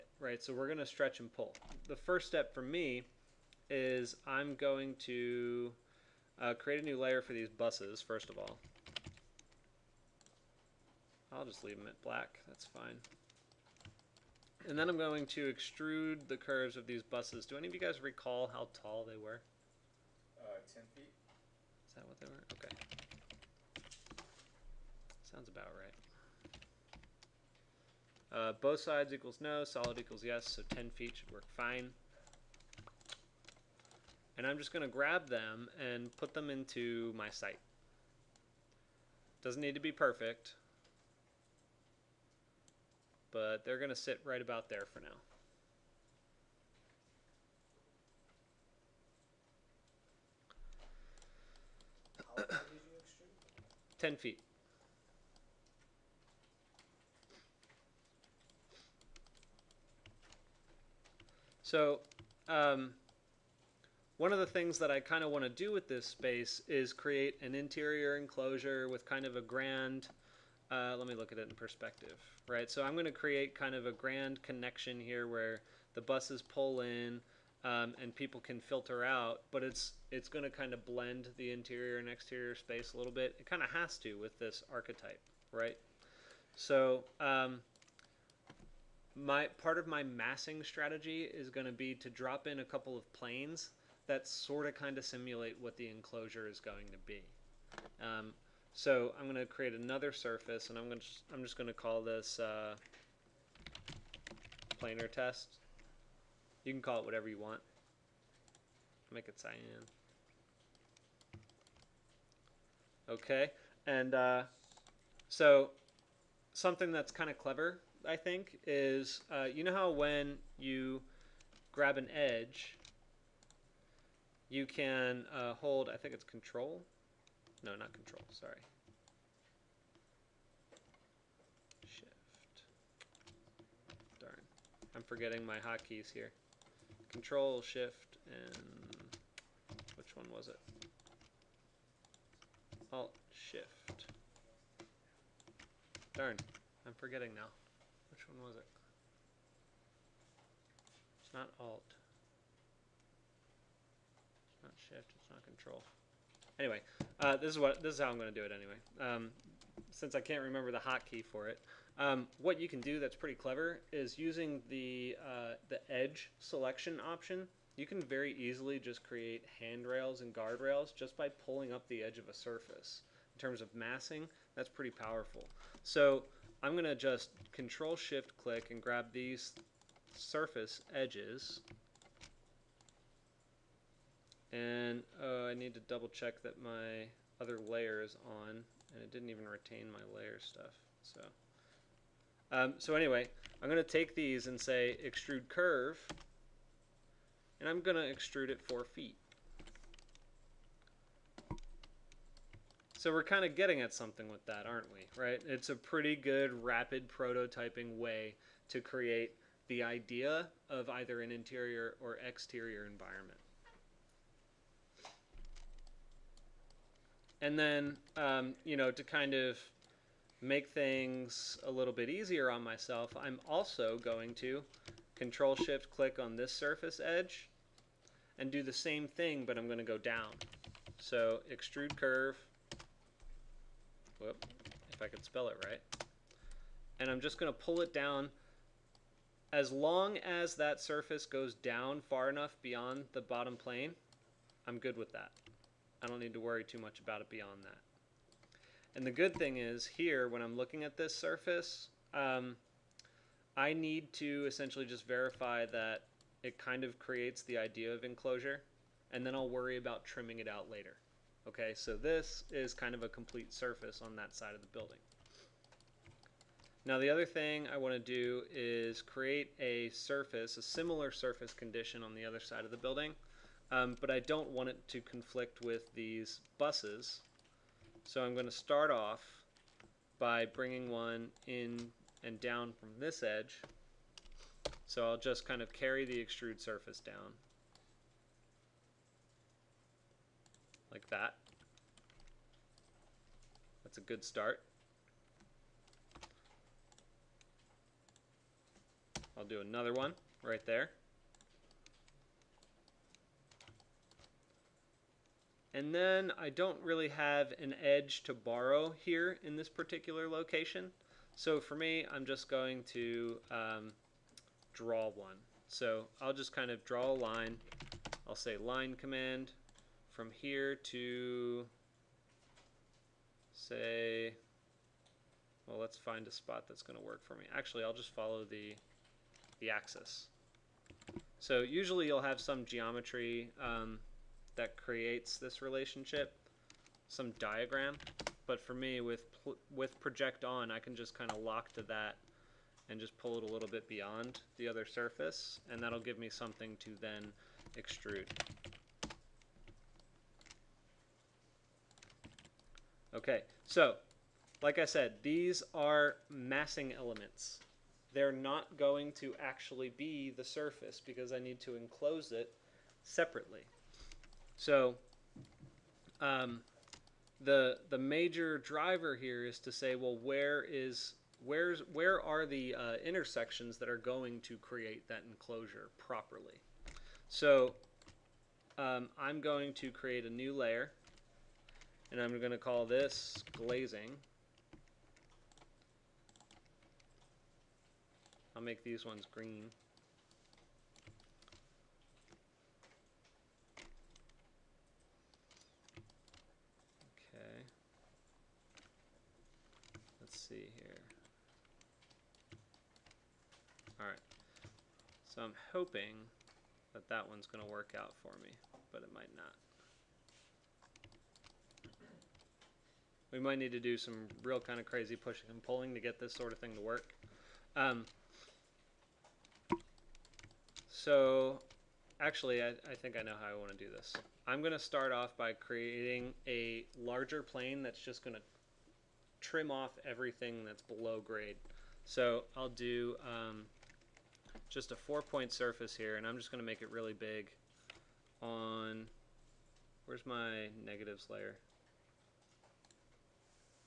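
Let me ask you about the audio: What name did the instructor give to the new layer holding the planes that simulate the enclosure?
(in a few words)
planar test.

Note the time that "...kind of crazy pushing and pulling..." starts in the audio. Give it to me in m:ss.
6:54.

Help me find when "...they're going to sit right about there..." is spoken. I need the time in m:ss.
0:43.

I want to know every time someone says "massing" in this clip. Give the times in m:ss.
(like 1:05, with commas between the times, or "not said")
1:30, 2:53, 5:56.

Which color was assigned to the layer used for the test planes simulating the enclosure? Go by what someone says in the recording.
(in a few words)
Cyan.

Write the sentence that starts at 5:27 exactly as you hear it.
Actually, I'll just follow the, the axis.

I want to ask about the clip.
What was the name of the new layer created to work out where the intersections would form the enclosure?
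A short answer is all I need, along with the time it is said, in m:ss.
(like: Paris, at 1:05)
glazing, at 6:23.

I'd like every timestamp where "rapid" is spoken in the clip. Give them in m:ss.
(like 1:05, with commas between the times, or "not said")
3:26.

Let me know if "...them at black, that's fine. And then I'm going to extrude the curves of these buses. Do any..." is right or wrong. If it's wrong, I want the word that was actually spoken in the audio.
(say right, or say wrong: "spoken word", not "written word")
right.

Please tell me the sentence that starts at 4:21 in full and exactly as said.
Okay, so this is kind of a complete surface on that side of the building.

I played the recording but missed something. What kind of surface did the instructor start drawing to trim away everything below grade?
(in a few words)
four point surface.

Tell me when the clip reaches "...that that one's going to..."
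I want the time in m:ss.
6:46.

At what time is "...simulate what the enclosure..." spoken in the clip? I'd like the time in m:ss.
1:35.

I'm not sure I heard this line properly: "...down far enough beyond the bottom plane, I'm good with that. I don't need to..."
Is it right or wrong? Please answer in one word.
right.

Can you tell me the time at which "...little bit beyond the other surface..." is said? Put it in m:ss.
5:43.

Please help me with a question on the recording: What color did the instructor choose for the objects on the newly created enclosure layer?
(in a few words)
Green.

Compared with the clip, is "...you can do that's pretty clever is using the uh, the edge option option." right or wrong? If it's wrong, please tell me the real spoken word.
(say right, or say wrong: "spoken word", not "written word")
wrong: "selection", not "option".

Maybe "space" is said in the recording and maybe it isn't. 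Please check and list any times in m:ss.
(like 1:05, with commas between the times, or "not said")
1:06, 1:22.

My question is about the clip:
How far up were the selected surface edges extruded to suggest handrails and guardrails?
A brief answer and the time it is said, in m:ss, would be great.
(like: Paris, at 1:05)
4 feet, at 3:18.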